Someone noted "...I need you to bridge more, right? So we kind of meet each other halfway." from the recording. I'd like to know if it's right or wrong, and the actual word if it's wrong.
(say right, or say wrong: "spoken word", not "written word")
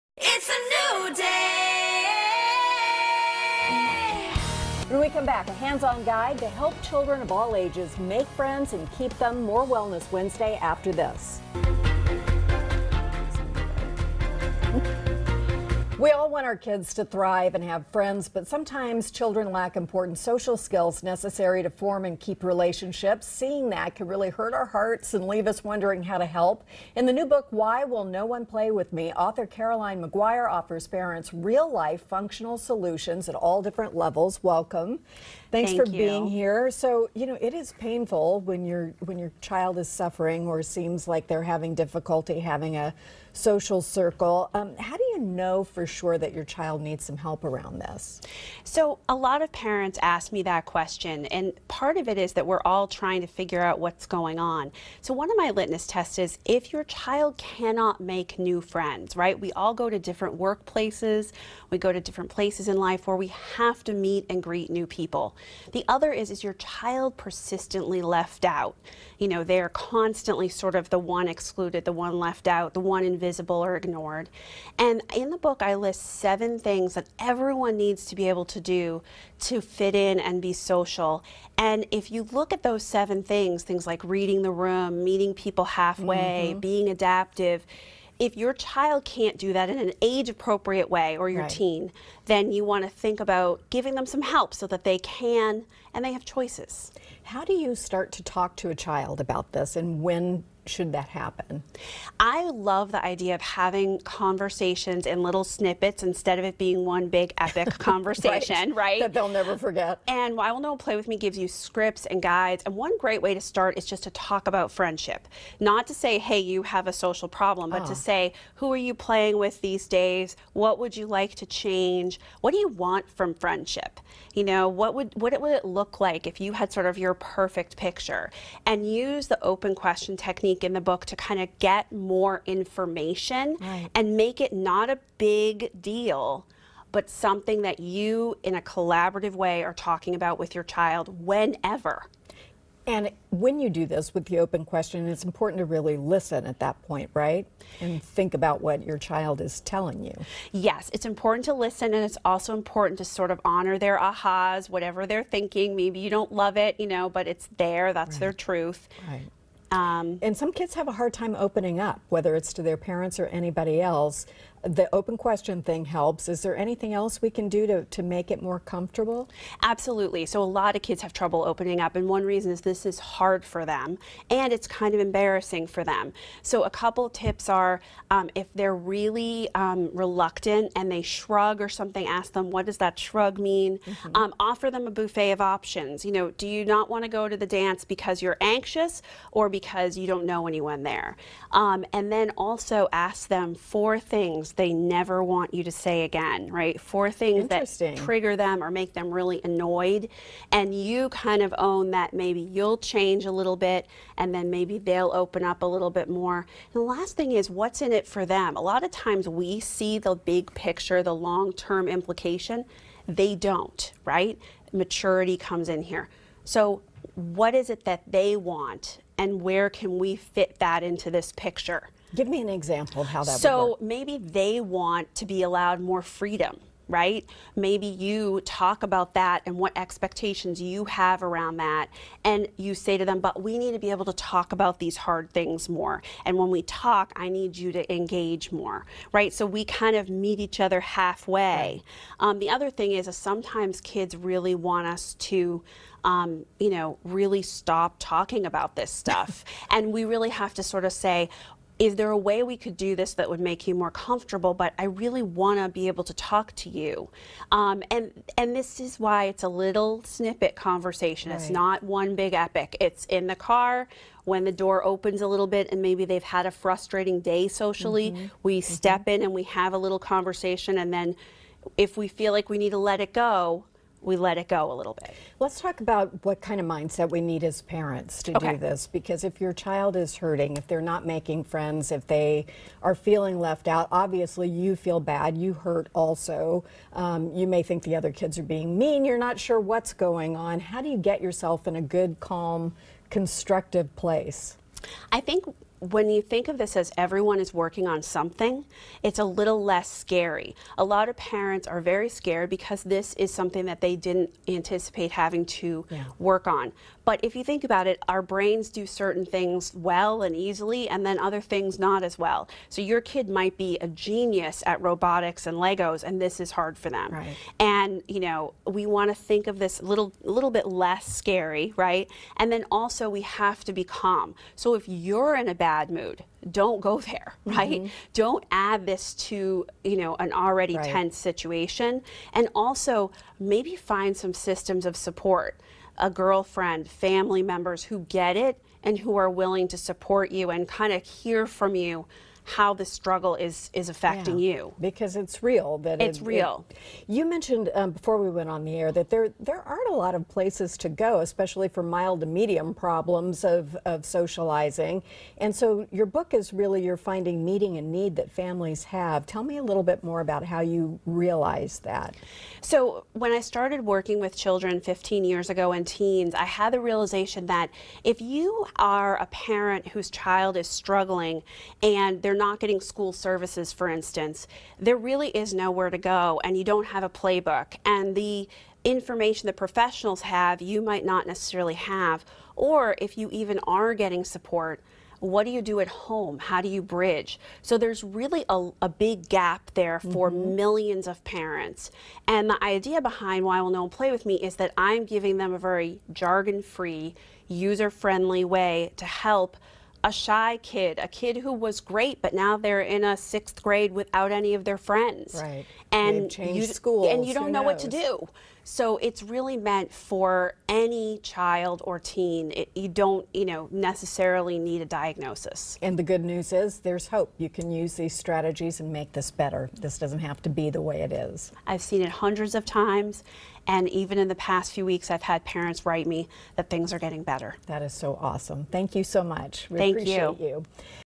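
wrong: "engage", not "bridge".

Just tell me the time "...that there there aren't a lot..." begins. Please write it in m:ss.
5:48.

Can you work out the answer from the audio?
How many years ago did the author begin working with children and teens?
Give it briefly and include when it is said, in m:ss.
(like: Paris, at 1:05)
15, at 6:04.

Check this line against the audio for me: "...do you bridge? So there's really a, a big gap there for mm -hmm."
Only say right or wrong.
right.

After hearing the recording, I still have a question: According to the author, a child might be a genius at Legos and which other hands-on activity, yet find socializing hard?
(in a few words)
Robotics.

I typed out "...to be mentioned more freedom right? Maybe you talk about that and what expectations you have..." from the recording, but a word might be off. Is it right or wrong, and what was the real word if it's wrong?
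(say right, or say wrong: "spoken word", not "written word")
wrong: "allowed", not "mentioned".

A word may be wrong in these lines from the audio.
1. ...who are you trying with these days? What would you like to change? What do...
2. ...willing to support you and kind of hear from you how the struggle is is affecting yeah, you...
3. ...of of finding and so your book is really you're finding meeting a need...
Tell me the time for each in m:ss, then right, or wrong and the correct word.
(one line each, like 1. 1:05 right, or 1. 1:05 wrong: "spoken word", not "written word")
1. 1:58 wrong: "playing", not "trying"
2. 5:39 right
3. 5:53 wrong: "socializing", not "finding".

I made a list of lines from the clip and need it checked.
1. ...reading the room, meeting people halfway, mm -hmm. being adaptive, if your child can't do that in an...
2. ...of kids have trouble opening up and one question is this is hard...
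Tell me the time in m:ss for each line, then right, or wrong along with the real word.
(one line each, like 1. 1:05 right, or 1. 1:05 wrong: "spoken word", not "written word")
1. 1:24 right
2. 2:50 wrong: "reason", not "question".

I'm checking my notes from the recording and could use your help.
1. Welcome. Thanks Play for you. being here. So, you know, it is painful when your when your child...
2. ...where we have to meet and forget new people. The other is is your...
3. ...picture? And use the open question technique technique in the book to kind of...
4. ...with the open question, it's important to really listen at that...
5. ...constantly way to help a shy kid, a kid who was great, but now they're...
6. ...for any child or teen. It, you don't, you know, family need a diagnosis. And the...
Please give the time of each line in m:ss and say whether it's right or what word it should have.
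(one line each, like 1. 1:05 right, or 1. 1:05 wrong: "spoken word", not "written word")
1. 0:34 wrong: "Thank", not "Play"
2. 1:03 wrong: "greet", not "forget"
3. 2:07 right
4. 2:24 right
5. 6:38 wrong: "friendly", not "constantly"
6. 6:49 wrong: "necessarily", not "family".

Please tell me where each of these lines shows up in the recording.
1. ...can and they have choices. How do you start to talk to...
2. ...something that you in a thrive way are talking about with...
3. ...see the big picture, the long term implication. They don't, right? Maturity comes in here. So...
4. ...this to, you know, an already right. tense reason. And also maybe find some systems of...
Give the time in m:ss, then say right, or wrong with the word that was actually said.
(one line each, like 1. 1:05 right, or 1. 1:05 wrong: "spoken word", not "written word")
1. 1:34 right
2. 2:17 wrong: "collaborative", not "thrive"
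3. 3:29 right
4. 5:28 wrong: "situation", not "reason".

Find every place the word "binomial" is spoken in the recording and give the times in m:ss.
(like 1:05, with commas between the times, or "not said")
not said.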